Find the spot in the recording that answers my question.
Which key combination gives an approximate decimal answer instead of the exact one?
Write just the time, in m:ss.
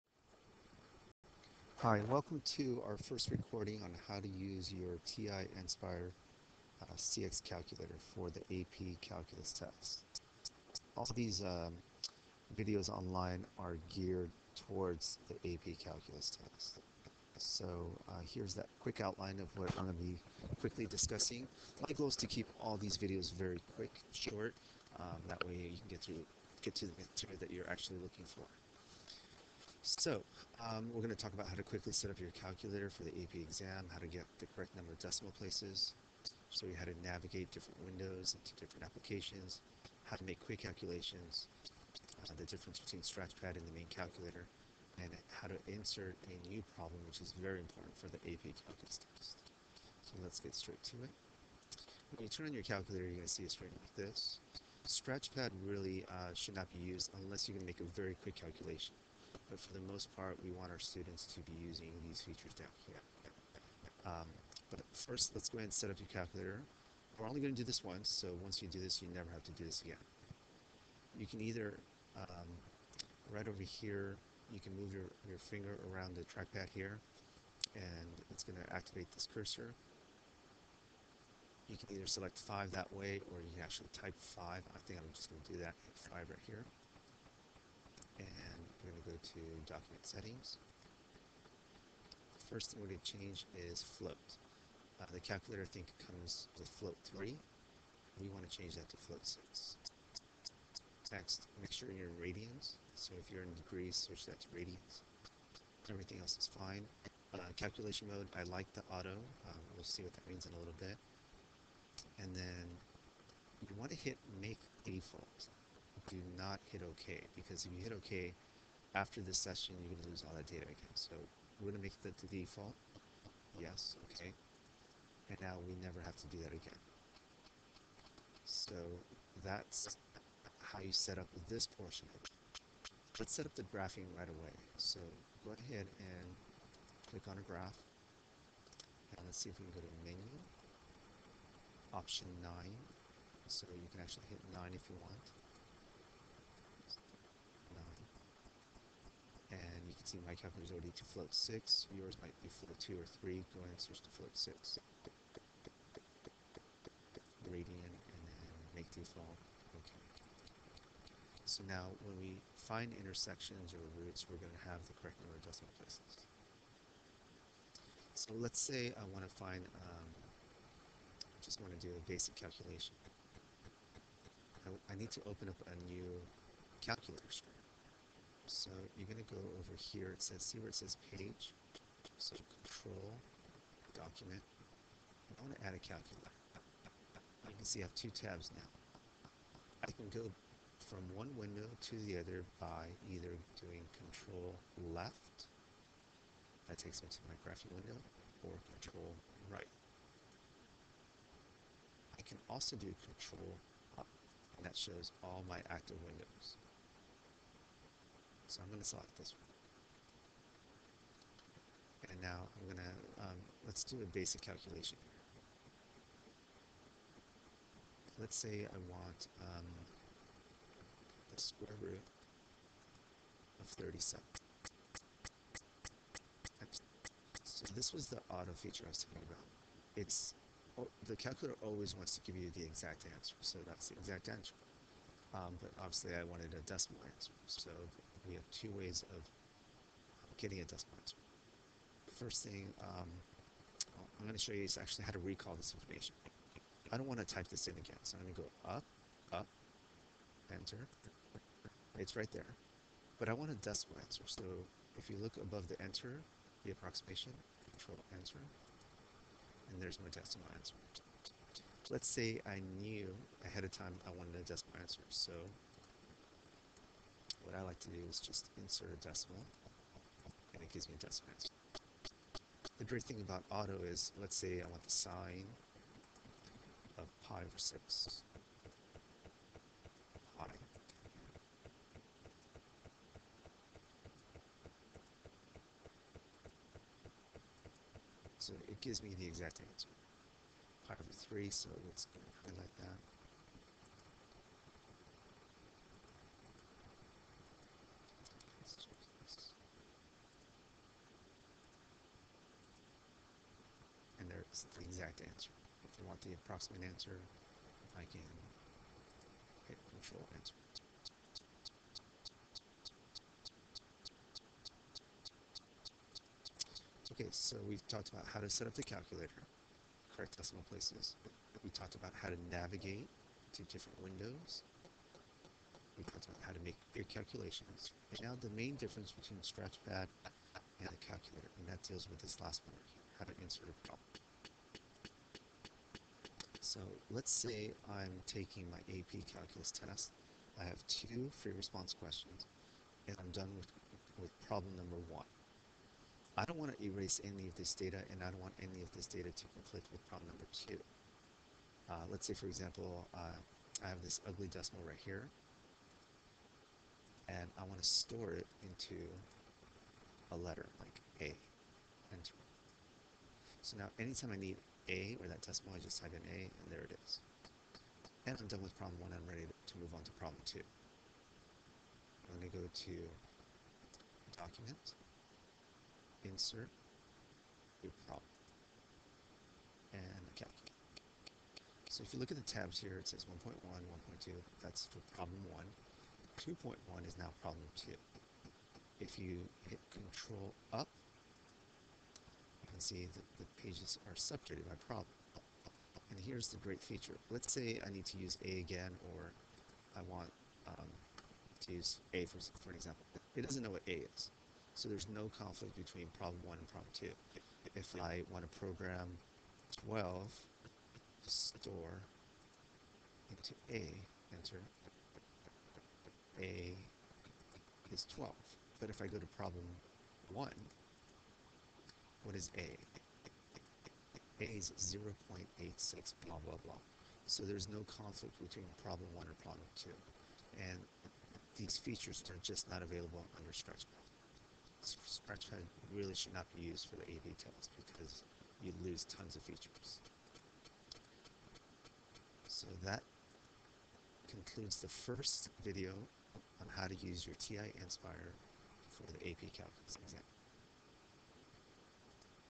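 4:17.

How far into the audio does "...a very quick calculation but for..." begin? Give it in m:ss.
0:57.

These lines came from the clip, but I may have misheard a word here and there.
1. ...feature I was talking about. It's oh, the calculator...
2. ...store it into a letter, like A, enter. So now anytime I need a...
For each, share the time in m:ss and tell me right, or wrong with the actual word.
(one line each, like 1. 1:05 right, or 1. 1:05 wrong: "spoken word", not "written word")
1. 3:48 right
2. 5:57 right.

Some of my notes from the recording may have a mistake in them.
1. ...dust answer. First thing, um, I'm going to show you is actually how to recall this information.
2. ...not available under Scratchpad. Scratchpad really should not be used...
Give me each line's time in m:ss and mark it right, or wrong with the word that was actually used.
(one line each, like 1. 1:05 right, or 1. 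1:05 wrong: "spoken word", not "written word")
1. 4:00 right
2. 7:12 right.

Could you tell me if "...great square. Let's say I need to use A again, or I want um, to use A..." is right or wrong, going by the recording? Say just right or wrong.
wrong.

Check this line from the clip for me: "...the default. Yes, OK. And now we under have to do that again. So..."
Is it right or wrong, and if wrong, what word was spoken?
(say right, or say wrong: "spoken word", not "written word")
wrong: "never", not "under".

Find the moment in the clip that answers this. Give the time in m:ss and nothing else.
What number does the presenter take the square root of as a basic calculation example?
3:41.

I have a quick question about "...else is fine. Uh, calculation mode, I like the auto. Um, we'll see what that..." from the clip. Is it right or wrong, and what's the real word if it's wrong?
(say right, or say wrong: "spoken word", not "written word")
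right.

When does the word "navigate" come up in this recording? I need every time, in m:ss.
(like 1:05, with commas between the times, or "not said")
0:37, 5:22.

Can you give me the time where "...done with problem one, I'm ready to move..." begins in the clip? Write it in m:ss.
6:08.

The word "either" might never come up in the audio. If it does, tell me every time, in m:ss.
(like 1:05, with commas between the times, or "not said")
1:11, 1:21, 3:13.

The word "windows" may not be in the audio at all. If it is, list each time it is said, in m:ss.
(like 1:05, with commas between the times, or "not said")
0:37, 3:11, 3:17, 3:26, 5:24.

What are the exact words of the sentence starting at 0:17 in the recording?
So uh, here's that quick outline of what I'm going to be quickly discussing.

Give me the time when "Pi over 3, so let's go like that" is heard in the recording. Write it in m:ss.
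4:50.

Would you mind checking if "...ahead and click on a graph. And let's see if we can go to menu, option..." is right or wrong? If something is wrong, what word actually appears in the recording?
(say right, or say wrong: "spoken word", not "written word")
right.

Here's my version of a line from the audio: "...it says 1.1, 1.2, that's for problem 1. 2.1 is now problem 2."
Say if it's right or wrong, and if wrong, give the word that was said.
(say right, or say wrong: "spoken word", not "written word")
right.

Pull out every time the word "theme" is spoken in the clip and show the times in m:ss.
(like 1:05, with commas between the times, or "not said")
not said.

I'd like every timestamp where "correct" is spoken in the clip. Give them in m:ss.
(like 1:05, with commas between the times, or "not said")
0:34, 2:44, 5:20.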